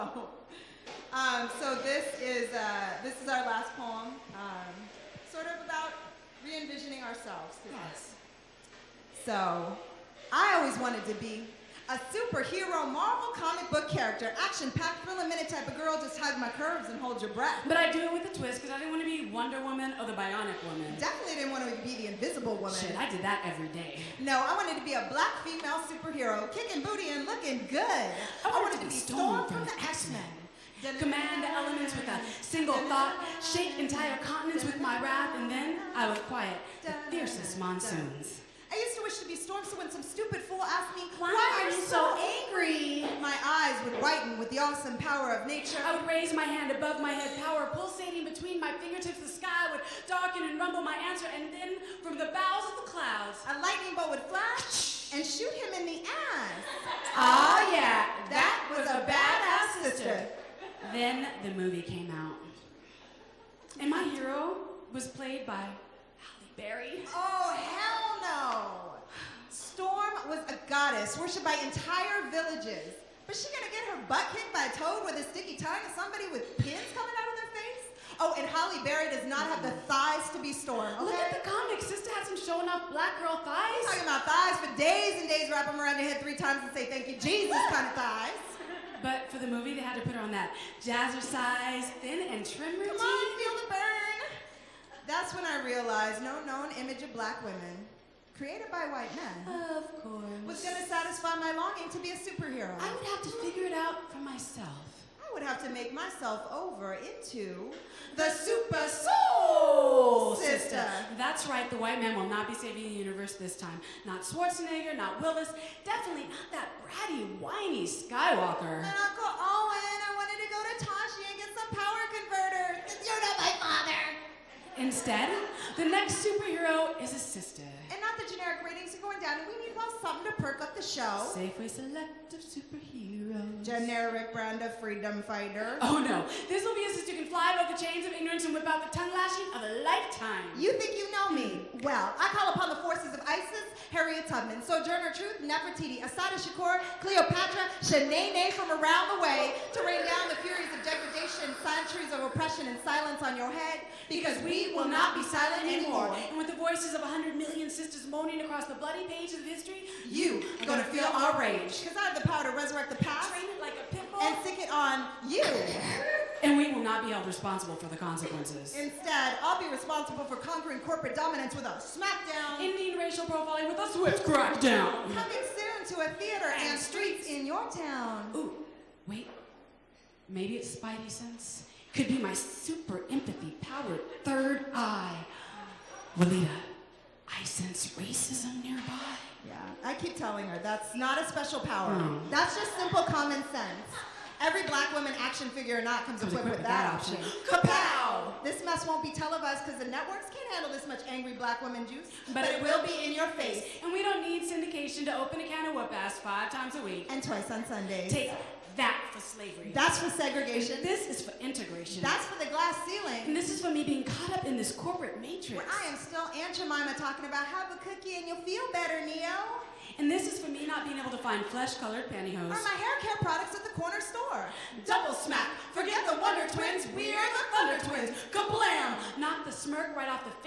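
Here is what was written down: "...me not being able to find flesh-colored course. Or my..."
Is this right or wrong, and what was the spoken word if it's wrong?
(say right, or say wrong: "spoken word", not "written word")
wrong: "pantyhose", not "course".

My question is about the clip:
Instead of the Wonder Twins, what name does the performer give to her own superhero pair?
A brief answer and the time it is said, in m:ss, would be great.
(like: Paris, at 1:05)
Thunder Twins, at 3:47.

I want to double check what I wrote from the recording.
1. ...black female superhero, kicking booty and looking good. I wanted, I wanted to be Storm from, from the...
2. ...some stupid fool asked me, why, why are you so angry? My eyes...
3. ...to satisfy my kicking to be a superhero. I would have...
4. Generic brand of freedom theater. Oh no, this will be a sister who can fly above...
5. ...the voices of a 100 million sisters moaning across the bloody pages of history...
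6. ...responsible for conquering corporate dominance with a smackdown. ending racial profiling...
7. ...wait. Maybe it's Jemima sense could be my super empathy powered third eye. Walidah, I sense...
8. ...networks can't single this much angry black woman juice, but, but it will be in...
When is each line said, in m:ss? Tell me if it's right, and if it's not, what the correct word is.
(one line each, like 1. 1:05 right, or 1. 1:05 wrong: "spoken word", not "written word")
1. 0:25 right
2. 0:39 right
3. 1:40 wrong: "longing", not "kicking"
4. 2:13 wrong: "fighter", not "theater"
5. 2:36 right
6. 2:49 right
7. 2:59 wrong: "Spidey", not "Jemima"
8. 3:19 wrong: "handle", not "single".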